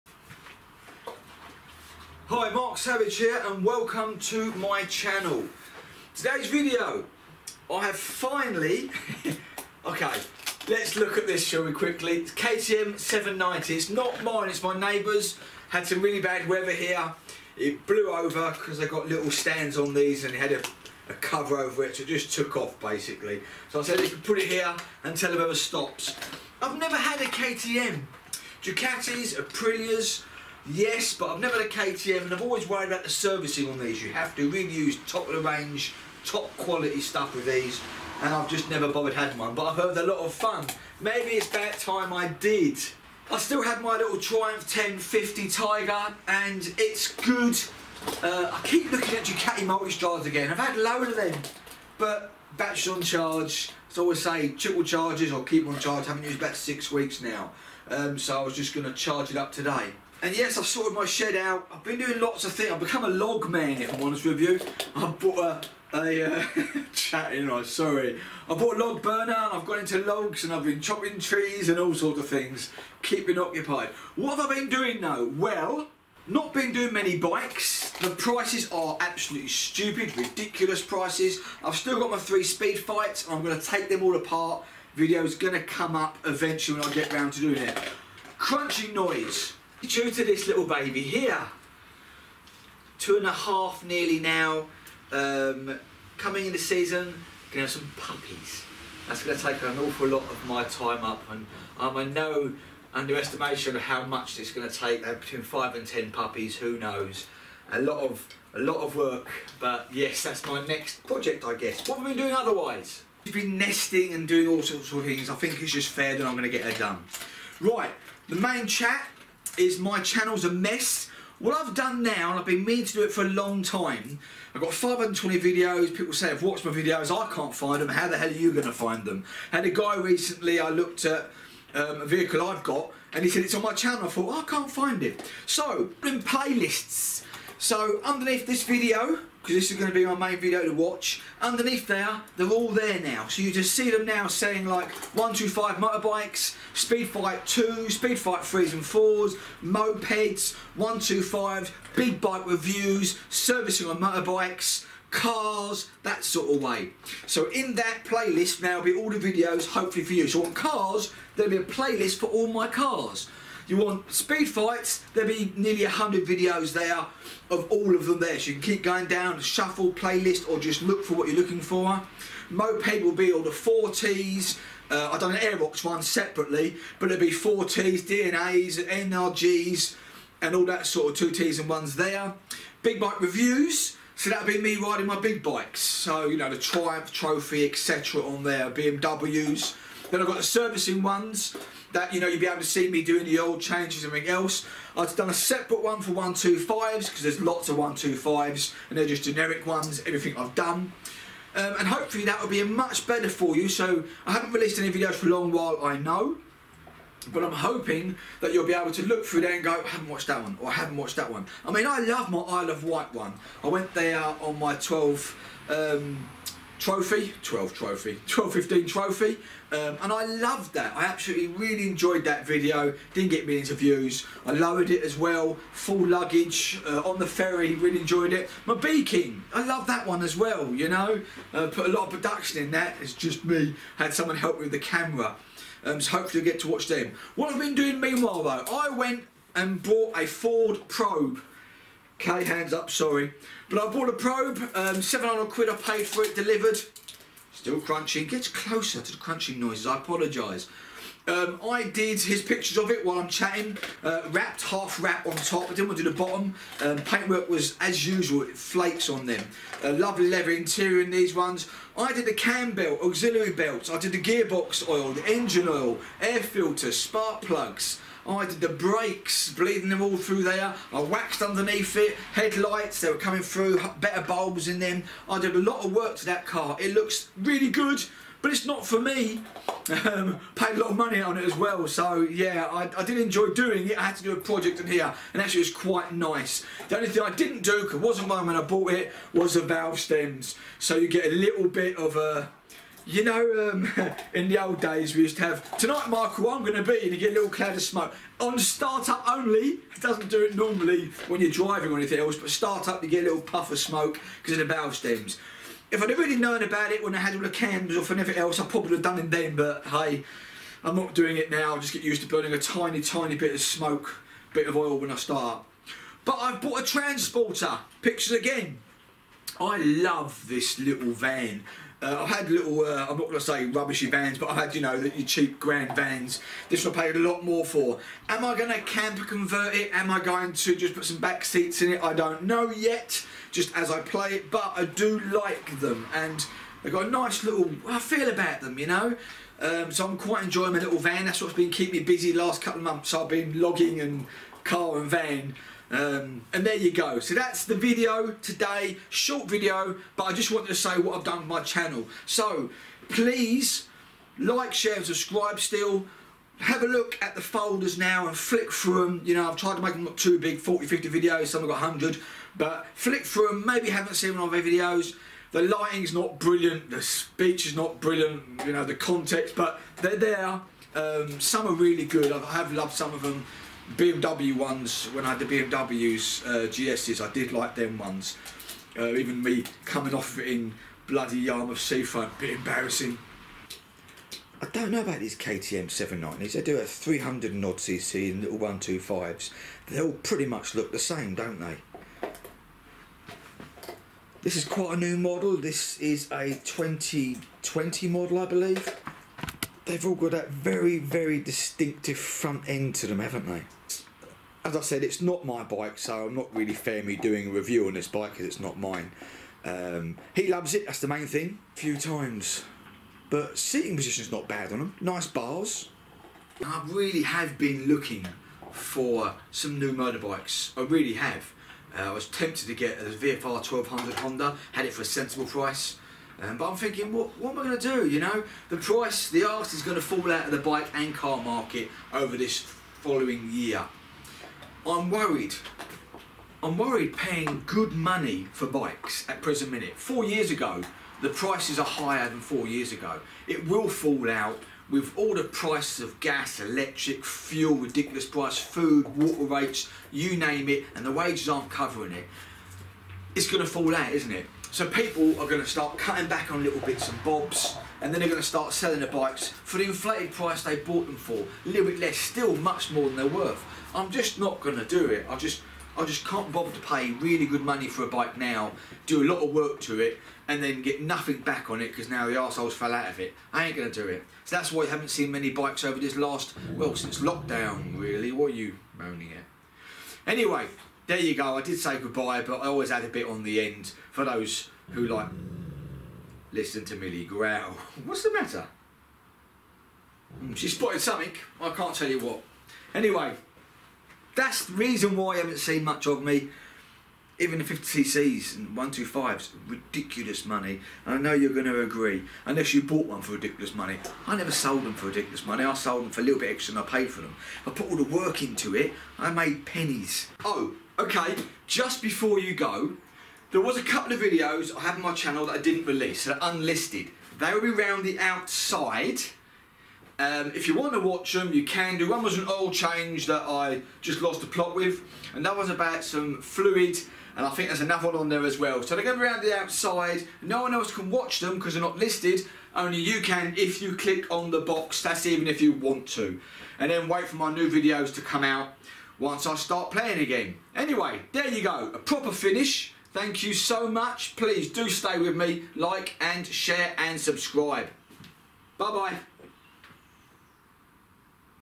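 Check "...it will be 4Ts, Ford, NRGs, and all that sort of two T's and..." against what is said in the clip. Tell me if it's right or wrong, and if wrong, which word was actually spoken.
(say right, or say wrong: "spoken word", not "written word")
wrong: "DNAs", not "Ford".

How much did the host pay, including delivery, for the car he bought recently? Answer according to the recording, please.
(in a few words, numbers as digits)
£700.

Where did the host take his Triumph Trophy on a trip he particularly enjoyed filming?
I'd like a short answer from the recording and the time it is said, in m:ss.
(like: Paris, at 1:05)
Isle of Wight, at 3:32.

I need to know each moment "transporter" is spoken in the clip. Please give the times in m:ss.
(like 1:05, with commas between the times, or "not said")
5:16.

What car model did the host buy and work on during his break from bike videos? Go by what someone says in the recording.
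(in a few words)
Ford Probe.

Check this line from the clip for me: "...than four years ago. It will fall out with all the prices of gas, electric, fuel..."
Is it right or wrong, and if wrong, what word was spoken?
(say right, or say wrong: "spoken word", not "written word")
right.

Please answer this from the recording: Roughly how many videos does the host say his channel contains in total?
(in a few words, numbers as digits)
520.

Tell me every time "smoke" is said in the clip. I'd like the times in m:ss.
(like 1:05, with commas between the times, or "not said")
4:57, 5:03, 5:13.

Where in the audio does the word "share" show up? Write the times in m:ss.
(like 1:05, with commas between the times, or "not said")
5:54, 9:06.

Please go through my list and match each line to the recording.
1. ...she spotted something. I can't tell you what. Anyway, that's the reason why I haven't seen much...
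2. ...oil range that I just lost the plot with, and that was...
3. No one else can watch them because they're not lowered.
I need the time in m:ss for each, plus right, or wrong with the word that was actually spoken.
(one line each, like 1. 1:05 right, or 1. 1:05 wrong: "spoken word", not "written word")
1. 8:10 right
2. 8:42 wrong: "change", not "range"
3. 8:50 wrong: "listed", not "lowered".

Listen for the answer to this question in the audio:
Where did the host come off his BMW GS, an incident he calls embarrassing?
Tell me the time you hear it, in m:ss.
6:21.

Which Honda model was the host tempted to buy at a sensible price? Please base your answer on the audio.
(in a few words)
VFR 1200.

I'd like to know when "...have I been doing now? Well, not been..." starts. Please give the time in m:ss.
1:14.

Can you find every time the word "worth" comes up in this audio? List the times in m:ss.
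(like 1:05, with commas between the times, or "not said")
7:43.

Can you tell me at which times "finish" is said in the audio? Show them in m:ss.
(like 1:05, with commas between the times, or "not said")
9:02.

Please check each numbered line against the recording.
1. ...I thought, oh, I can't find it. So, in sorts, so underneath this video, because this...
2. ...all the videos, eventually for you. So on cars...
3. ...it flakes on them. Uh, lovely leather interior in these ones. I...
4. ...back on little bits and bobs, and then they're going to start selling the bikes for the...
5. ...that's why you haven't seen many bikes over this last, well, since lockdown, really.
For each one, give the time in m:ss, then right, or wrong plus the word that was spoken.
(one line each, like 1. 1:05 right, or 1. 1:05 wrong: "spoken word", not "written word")
1. 2:14 wrong: "playlists", not "sorts"
2. 2:38 wrong: "hopefully", not "eventually"
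3. 4:18 right
4. 7:36 right
5. 7:54 right.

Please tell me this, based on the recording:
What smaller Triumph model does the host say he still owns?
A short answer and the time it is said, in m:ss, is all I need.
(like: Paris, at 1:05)
Triumph 1050 Tiger, at 0:44.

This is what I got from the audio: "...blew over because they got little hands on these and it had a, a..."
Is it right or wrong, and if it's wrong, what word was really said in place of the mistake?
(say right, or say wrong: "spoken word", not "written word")
wrong: "stands", not "hands".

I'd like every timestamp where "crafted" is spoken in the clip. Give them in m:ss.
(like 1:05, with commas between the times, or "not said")
not said.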